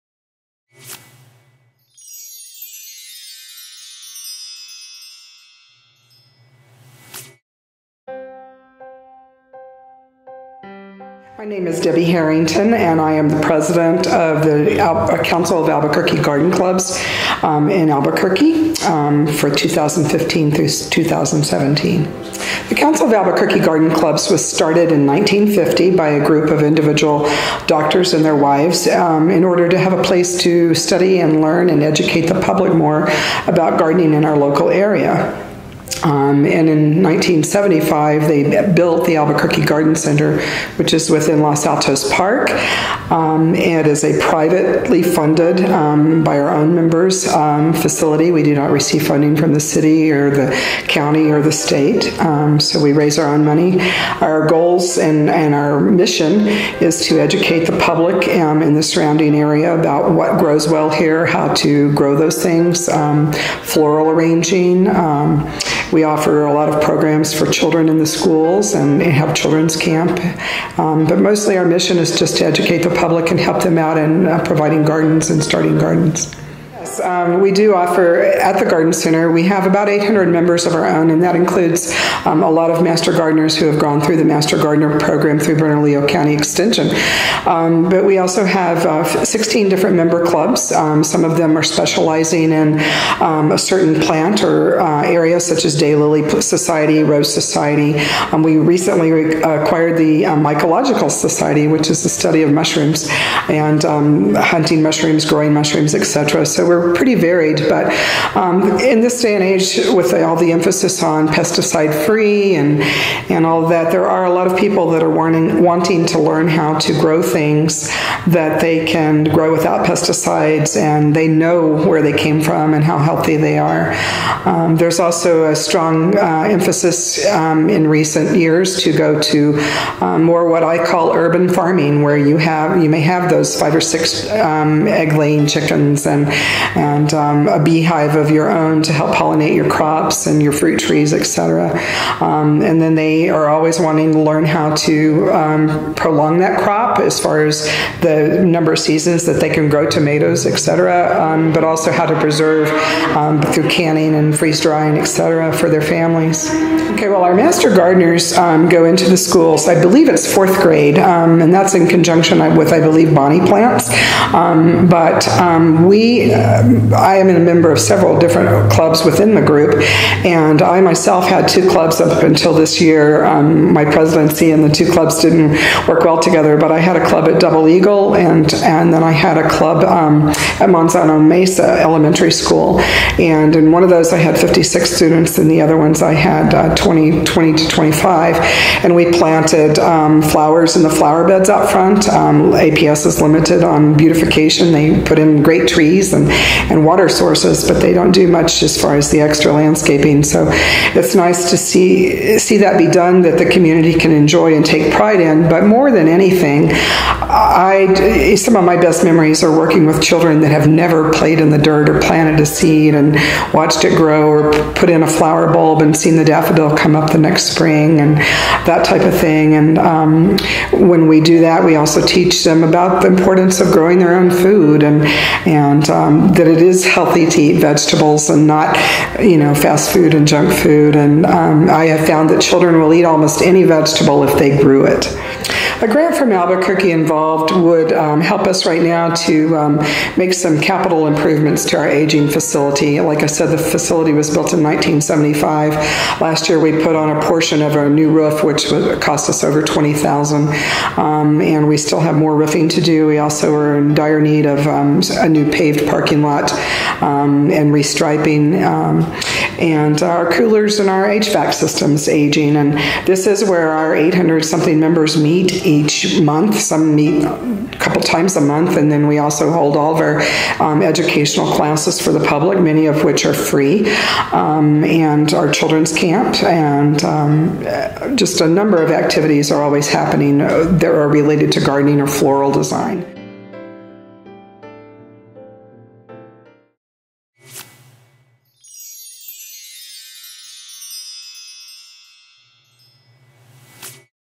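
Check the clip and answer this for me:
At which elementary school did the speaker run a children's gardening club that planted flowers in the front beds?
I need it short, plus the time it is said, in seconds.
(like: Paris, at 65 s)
Manzano Mesa Elementary School, at 180 s.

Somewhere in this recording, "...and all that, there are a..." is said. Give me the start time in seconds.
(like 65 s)
113 s.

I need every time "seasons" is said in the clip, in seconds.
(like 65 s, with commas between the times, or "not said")
148 s.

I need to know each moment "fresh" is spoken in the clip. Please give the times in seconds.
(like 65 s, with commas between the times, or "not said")
not said.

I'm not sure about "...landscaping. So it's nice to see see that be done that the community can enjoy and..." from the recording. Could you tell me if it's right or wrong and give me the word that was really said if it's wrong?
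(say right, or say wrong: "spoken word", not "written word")
right.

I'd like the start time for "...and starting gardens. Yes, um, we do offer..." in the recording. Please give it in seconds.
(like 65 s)
75 s.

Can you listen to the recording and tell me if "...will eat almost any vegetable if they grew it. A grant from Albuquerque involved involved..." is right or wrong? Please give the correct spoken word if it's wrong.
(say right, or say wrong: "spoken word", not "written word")
right.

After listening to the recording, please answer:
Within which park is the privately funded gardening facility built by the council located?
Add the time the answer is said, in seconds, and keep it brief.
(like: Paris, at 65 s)
Los Altos Park, at 41 s.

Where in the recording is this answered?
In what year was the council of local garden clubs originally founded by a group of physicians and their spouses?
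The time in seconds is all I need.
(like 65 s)
25 s.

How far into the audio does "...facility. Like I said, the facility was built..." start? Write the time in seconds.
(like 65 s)
242 s.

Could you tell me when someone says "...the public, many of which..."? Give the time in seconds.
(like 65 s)
272 s.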